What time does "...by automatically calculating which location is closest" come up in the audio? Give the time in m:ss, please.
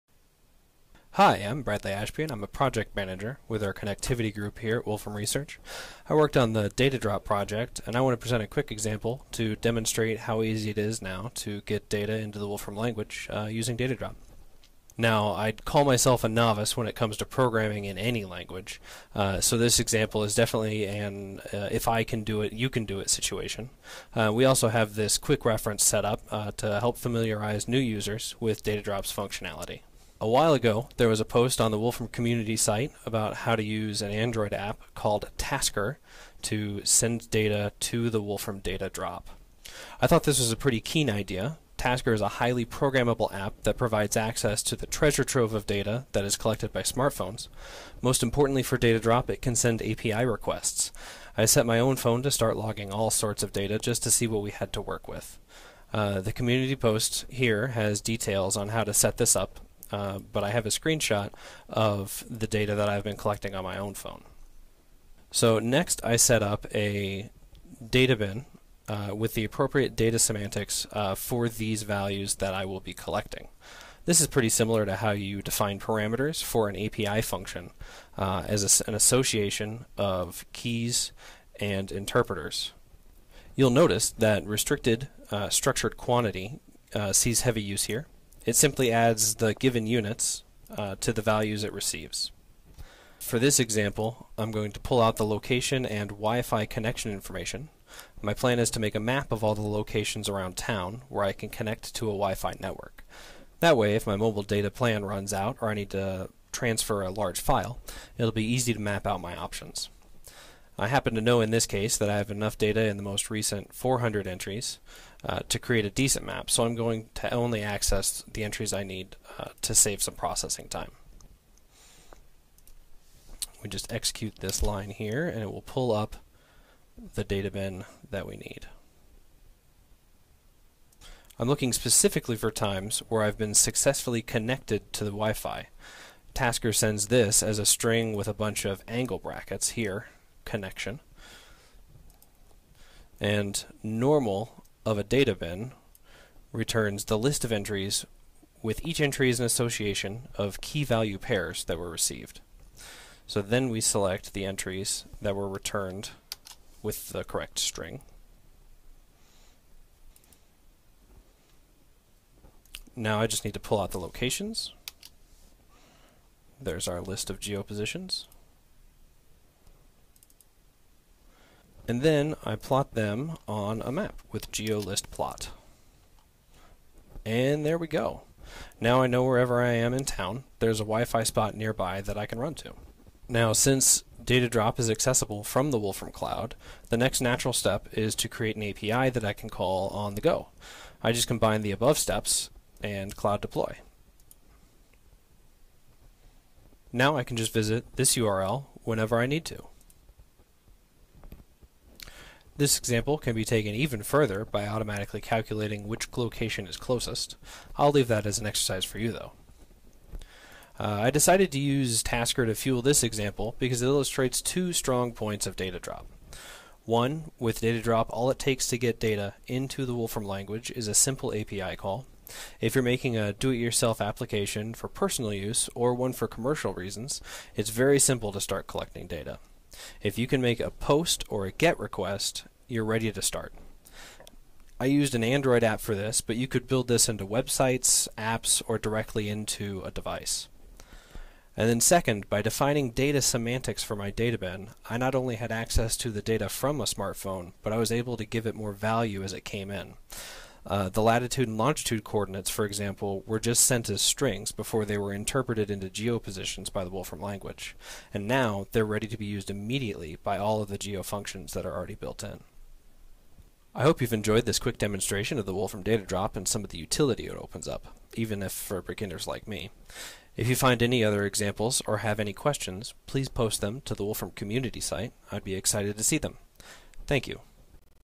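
3:24.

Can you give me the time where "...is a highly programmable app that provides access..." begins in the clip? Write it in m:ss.
0:42.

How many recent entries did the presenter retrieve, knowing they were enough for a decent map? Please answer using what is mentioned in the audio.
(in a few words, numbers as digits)
400.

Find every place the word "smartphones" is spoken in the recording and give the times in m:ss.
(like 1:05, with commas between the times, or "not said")
0:46, 4:06.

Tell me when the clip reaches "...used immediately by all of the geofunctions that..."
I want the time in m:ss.
4:19.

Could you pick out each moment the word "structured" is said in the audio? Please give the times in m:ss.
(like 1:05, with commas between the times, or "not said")
1:25.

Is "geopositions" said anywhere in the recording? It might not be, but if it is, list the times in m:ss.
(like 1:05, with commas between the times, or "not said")
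2:47, 4:15.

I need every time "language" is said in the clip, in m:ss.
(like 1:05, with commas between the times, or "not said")
0:12, 0:18, 3:40, 4:17.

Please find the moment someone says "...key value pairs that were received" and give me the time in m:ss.
2:30.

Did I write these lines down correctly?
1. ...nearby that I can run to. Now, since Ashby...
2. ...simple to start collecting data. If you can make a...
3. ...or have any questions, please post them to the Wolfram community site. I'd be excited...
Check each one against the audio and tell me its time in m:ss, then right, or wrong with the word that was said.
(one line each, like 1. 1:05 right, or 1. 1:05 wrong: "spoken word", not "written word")
1. 3:01 wrong: "Datadrop", not "Ashby"
2. 3:47 right
3. 4:31 right.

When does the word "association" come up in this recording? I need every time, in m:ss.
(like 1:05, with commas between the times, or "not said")
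1:18, 2:29.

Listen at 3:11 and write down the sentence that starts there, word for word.
I just combine the above steps and cloud deploy.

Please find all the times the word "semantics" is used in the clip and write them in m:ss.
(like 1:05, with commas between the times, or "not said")
1:10, 4:03.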